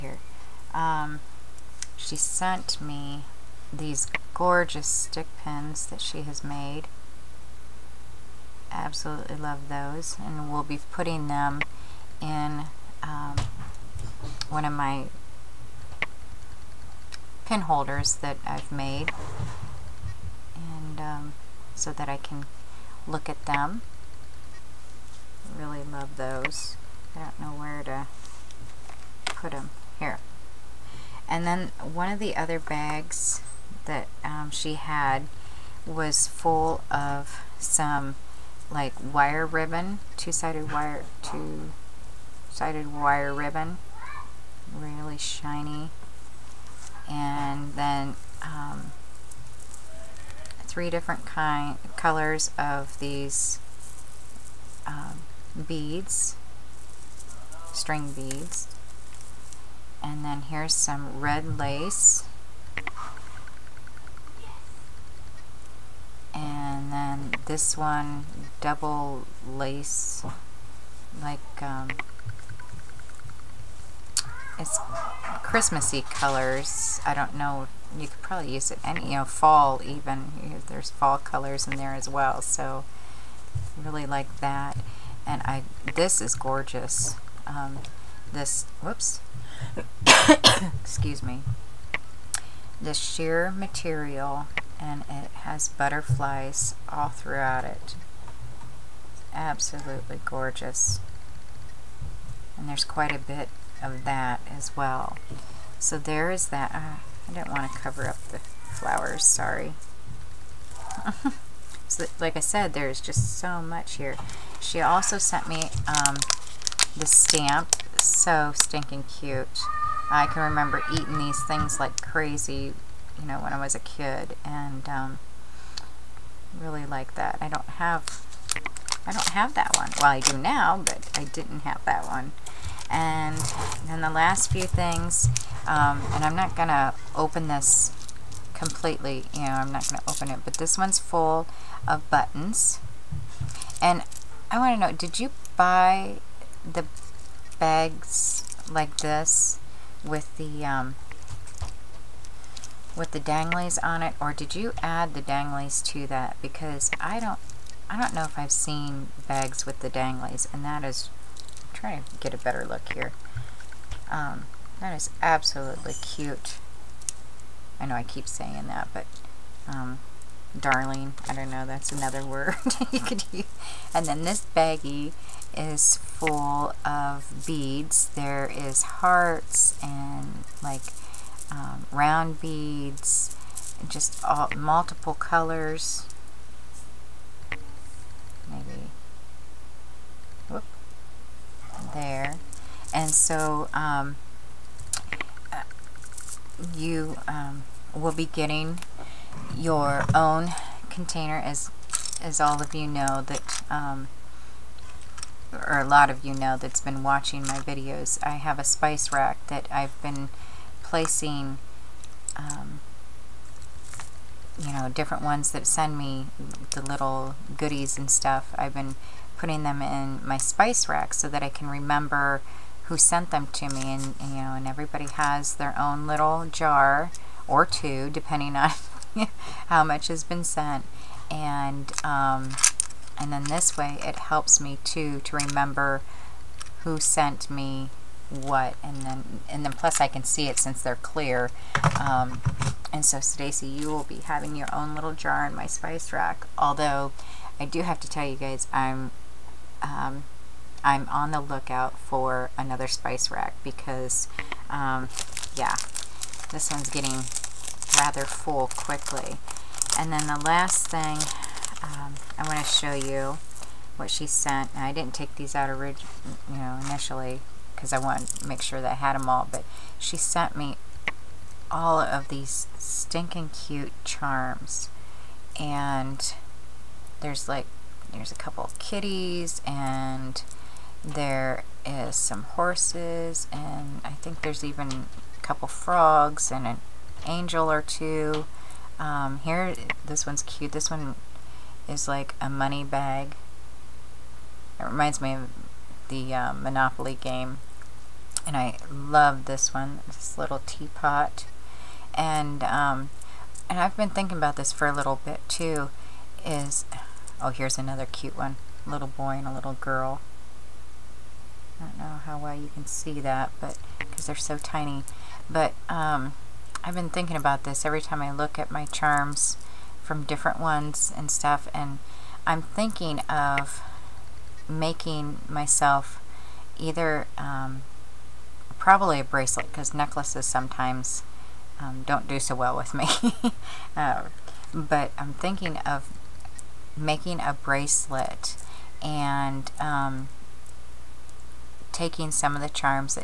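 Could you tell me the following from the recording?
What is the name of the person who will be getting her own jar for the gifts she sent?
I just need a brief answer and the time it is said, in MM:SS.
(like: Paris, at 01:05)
Stacy, at 04:03.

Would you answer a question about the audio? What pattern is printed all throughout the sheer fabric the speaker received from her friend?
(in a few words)
Butterflies.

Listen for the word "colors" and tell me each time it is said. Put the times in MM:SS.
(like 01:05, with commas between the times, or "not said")
00:51, 01:16, 01:21, 03:05.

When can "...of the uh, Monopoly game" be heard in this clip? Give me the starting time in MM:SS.
04:55.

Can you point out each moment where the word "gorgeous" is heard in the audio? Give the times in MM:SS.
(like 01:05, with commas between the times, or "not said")
00:04, 01:26, 01:40.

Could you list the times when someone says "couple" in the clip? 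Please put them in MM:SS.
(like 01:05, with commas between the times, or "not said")
04:38, 04:45.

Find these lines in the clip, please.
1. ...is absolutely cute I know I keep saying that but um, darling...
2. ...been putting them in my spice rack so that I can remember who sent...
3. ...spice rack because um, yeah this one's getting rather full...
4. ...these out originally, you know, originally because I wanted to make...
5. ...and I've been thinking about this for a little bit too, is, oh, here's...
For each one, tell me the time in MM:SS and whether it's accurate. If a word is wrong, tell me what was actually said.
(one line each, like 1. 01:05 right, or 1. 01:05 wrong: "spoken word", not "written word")
1. 02:44 right
2. 03:38 right
3. 04:12 right
4. 04:25 wrong: "initially", not "originally"
5. 05:03 right.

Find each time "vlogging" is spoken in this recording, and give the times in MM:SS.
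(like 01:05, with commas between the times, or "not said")
not said.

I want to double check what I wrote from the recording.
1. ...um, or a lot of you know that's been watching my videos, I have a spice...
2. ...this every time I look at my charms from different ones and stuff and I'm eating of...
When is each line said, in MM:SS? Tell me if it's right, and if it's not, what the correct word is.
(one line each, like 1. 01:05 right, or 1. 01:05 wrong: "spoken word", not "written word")
1. 03:23 right
2. 05:17 wrong: "thinking", not "eating".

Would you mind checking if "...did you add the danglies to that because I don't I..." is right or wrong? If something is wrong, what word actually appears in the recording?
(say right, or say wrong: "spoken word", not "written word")
right.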